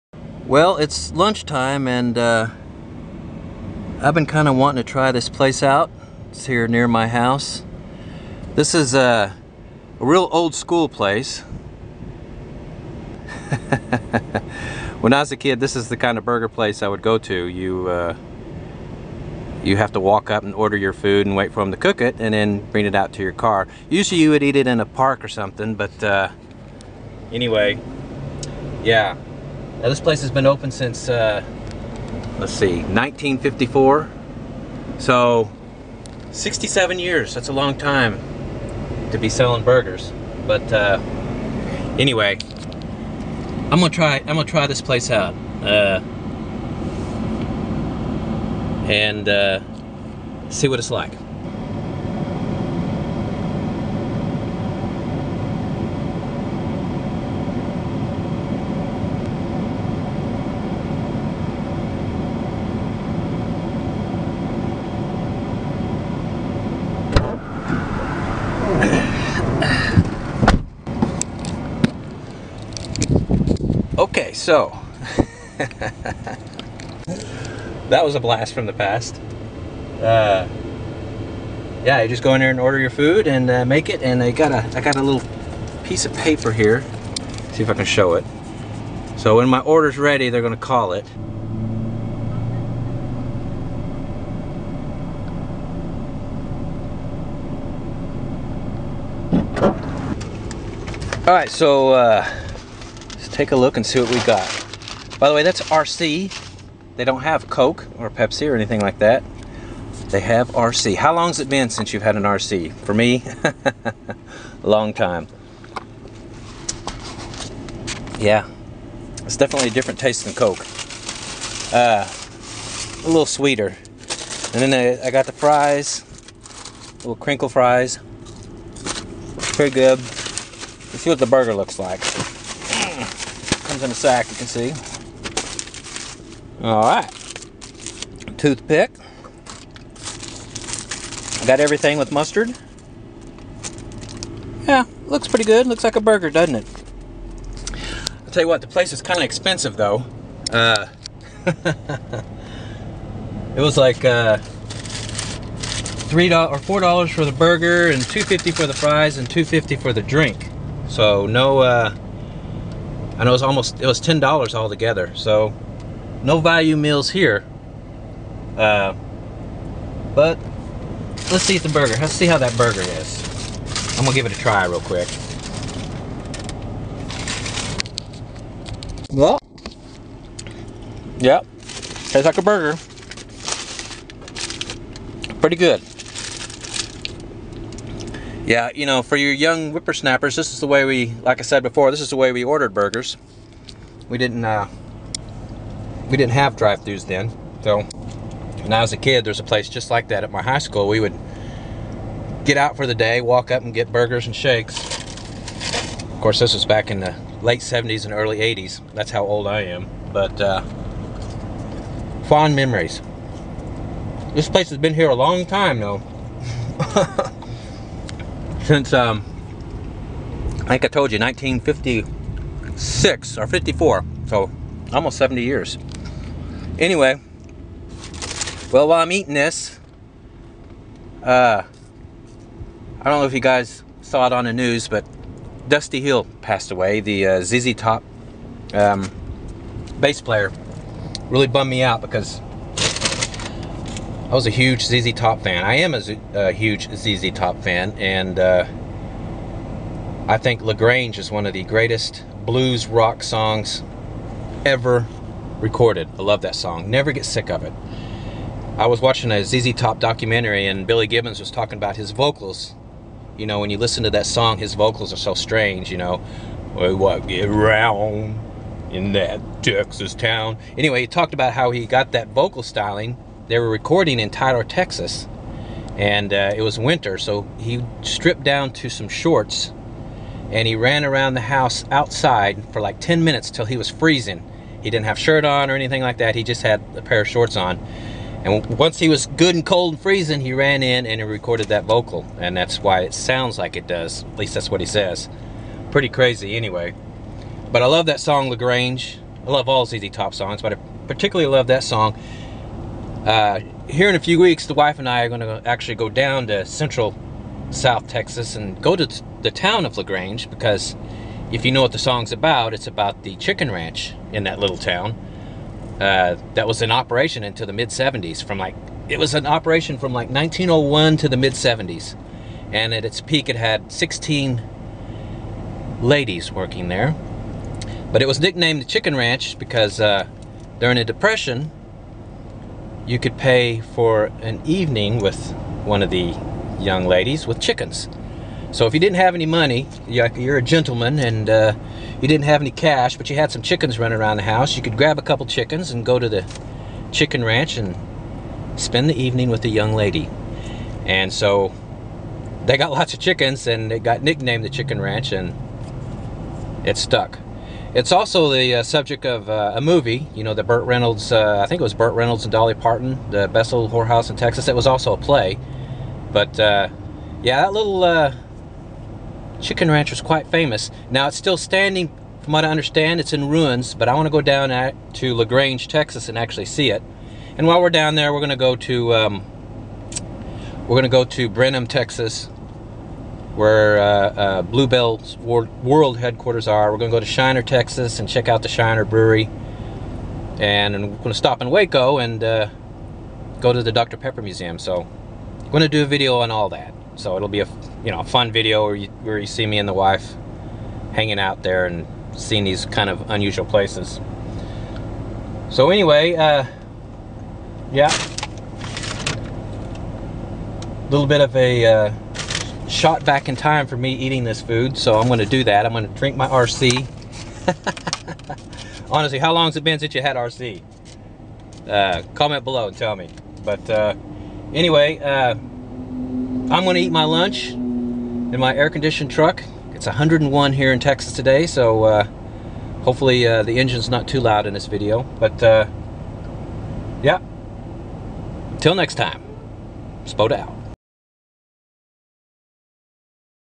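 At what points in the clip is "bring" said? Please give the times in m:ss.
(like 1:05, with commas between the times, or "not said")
0:22.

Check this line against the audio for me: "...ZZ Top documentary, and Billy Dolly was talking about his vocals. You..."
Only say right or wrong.
wrong.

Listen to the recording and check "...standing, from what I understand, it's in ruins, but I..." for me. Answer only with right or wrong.
right.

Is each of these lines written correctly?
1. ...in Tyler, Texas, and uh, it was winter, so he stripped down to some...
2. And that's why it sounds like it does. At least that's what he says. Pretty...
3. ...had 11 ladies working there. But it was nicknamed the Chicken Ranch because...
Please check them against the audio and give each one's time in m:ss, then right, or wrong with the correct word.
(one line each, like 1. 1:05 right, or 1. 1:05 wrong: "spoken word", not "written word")
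1. 4:34 right
2. 4:52 right
3. 5:23 wrong: "16", not "11".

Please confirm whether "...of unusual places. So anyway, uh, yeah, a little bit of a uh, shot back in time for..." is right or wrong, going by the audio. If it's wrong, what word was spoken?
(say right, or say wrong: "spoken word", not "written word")
right.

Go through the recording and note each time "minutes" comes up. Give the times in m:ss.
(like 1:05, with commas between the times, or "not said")
4:43.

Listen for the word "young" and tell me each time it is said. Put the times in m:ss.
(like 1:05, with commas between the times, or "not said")
3:09, 5:36, 5:49.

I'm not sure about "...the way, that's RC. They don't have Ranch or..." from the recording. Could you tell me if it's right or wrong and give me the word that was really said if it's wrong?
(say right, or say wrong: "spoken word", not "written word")
wrong: "Coke", not "Ranch".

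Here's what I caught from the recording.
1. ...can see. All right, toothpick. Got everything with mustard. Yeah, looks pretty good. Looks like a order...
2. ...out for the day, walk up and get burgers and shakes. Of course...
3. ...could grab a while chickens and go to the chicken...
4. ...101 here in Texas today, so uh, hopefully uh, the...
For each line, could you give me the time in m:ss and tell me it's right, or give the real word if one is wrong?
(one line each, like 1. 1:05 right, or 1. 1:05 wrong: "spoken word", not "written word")
1. 2:14 wrong: "burger", not "order"
2. 3:22 right
3. 5:44 wrong: "couple", not "while"
4. 7:10 right.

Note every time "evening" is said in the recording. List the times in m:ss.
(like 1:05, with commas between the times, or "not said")
5:34, 5:49.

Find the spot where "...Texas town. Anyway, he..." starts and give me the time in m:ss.
4:29.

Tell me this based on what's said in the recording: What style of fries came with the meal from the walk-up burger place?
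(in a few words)
crinkle fries.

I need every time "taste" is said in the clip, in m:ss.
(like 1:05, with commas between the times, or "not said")
1:59, 3:02.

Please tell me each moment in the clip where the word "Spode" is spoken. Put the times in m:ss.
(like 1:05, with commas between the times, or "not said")
7:20.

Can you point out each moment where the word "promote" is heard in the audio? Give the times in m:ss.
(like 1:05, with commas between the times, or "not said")
not said.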